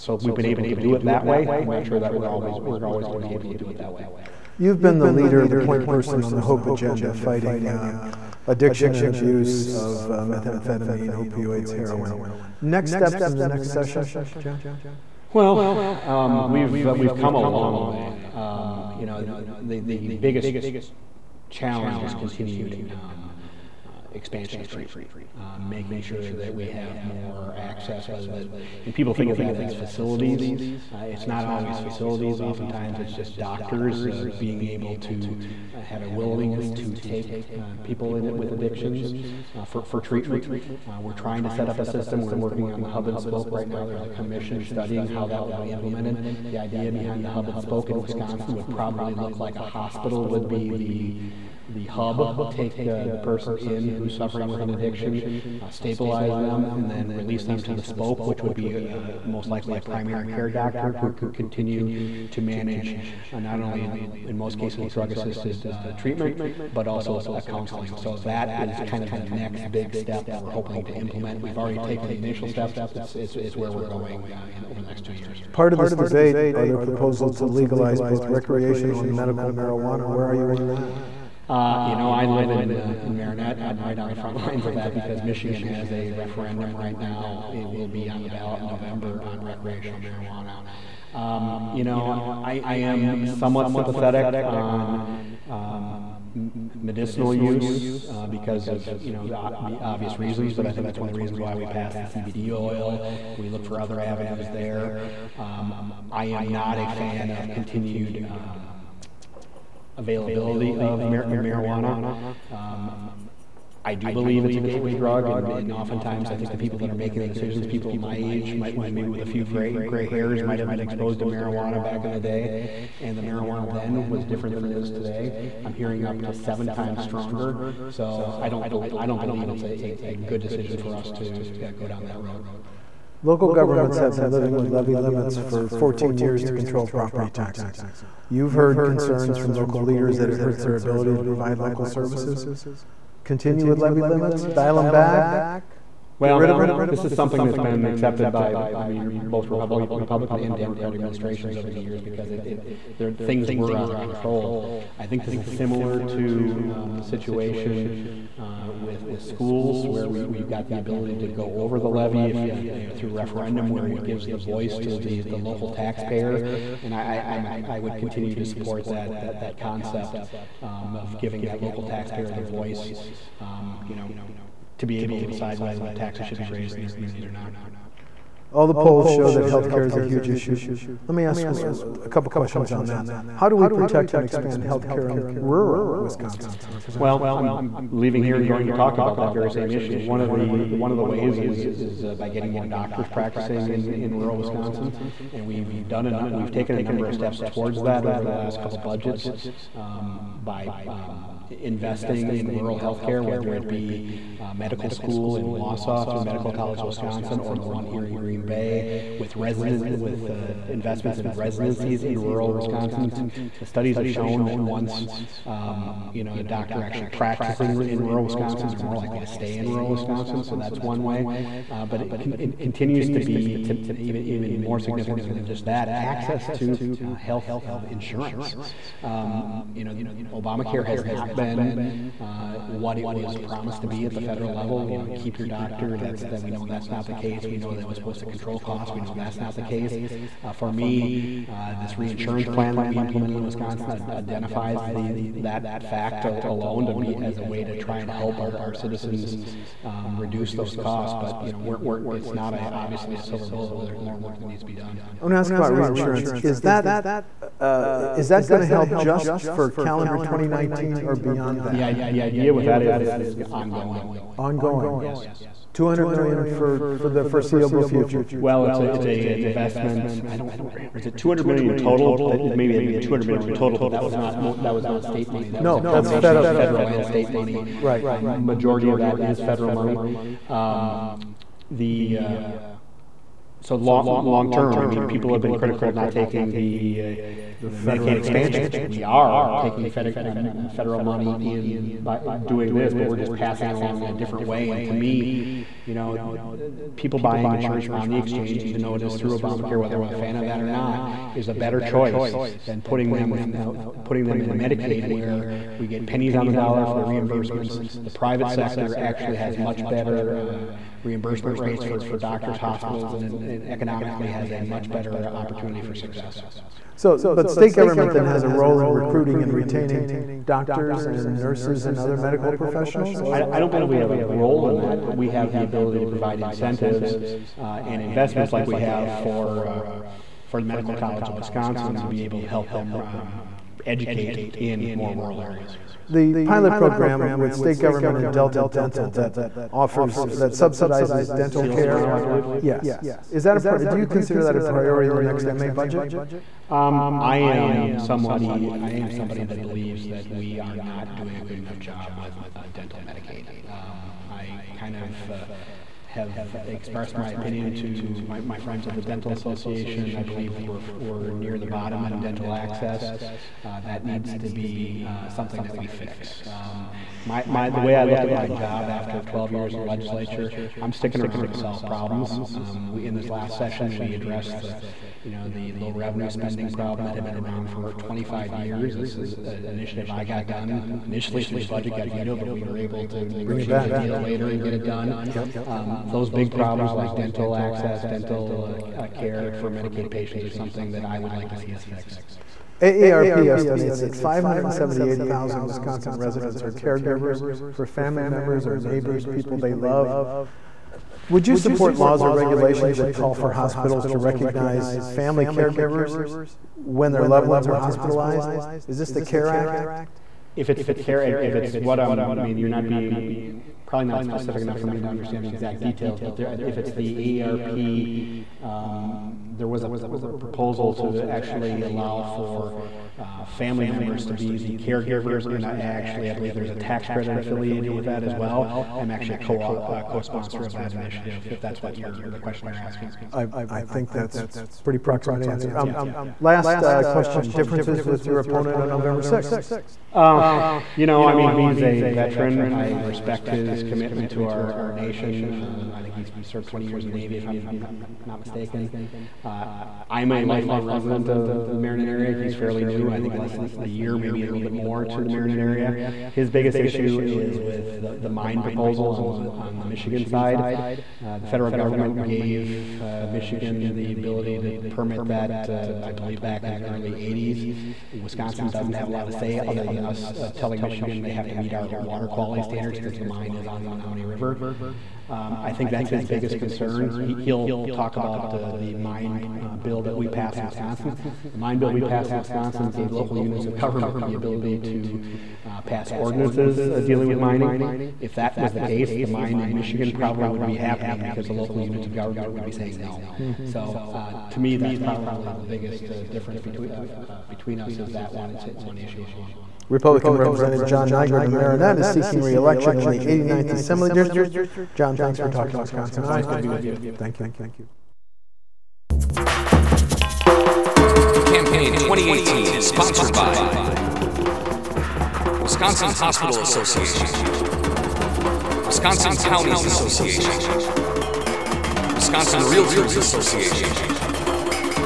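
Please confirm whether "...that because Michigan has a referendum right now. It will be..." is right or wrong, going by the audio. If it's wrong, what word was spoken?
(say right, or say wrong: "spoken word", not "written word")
right.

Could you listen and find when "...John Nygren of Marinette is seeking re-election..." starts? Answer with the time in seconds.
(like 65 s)
500 s.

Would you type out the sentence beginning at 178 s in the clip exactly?
All the polls show that health care is a huge issue.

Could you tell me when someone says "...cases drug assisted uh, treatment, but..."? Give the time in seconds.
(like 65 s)
64 s.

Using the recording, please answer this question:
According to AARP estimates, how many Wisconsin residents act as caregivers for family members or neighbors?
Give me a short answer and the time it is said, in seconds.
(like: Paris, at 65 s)
578,000, at 394 s.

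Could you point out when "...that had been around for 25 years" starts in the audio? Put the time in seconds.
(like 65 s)
377 s.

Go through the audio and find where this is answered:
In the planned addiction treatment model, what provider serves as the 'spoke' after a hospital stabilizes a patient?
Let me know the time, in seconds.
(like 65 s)
59 s.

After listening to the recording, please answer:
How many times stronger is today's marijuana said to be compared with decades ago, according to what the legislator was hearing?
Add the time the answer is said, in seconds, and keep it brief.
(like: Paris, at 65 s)
7, at 126 s.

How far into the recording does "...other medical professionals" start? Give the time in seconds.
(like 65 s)
321 s.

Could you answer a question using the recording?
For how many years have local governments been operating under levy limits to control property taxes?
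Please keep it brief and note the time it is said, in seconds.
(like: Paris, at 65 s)
14, at 135 s.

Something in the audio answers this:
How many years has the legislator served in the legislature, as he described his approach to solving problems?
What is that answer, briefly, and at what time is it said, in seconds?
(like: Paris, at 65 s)
12, at 369 s.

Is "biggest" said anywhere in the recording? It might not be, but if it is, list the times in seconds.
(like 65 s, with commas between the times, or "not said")
20 s, 456 s, 476 s, 495 s.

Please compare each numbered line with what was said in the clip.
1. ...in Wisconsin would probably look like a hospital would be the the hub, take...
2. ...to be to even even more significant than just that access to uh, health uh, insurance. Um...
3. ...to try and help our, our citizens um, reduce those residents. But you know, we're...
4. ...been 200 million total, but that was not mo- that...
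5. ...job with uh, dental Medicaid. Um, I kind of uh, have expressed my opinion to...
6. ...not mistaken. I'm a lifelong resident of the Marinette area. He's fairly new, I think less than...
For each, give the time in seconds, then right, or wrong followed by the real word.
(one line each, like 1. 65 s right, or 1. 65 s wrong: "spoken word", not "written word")
1. 47 s right
2. 223 s right
3. 247 s wrong: "costs", not "residents"
4. 272 s right
5. 351 s right
6. 448 s right.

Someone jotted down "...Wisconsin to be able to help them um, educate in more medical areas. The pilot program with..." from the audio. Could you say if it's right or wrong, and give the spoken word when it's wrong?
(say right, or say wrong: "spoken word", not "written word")
wrong: "rural", not "medical".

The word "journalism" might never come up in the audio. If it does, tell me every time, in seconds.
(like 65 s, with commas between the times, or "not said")
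not said.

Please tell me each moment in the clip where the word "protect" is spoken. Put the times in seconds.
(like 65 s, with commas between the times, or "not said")
183 s.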